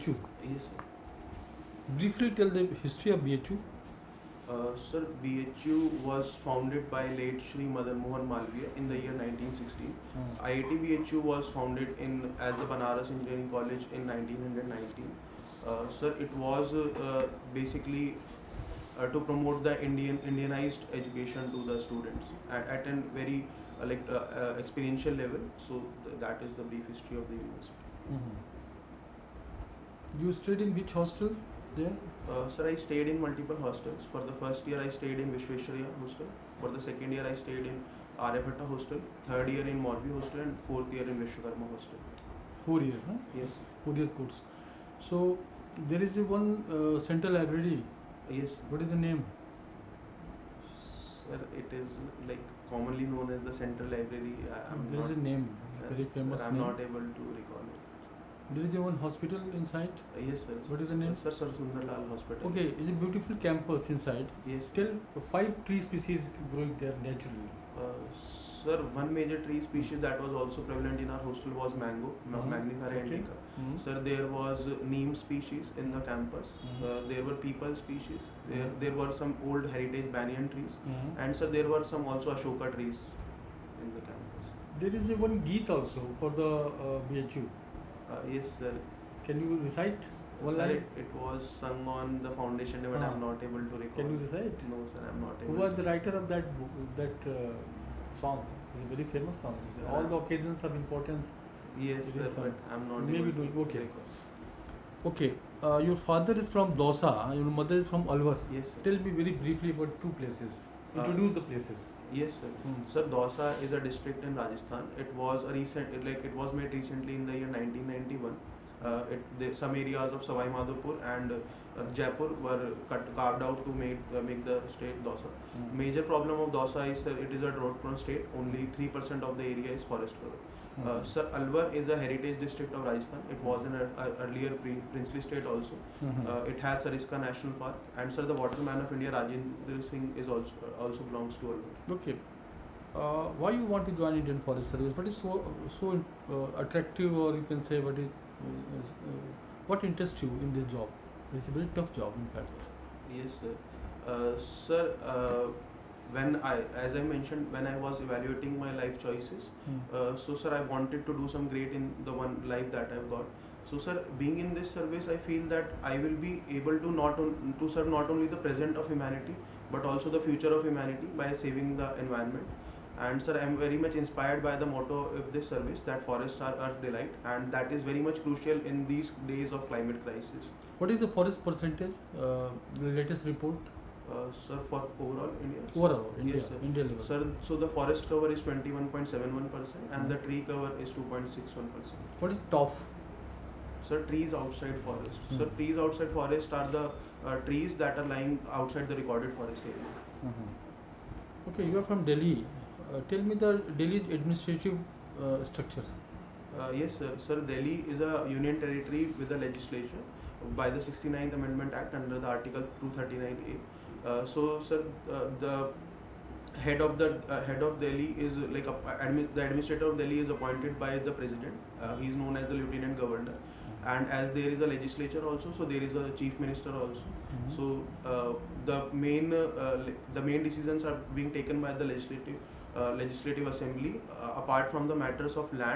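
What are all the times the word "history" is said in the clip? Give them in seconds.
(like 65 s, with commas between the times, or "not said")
2 s, 26 s.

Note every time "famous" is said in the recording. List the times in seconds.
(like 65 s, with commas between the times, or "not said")
56 s, 99 s.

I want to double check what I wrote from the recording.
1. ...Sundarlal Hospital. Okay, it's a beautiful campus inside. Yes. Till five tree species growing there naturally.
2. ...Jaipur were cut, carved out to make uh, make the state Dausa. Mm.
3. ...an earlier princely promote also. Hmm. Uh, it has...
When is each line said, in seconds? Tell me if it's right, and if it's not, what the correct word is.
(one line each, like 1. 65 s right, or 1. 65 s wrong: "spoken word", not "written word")
1. 61 s right
2. 121 s right
3. 133 s wrong: "state", not "promote".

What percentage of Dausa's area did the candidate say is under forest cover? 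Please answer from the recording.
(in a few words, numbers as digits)
3%.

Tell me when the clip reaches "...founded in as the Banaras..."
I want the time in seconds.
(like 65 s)
11 s.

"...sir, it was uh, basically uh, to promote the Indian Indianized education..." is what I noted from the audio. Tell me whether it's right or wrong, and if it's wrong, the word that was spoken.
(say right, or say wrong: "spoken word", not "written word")
right.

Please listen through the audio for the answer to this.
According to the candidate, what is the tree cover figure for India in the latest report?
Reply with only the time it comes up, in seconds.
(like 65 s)
190 s.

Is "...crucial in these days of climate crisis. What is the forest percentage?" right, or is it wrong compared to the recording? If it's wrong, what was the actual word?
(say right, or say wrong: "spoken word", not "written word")
right.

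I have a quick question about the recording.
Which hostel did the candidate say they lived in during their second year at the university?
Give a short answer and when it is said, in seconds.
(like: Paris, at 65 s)
Aryabhatta hostel, at 38 s.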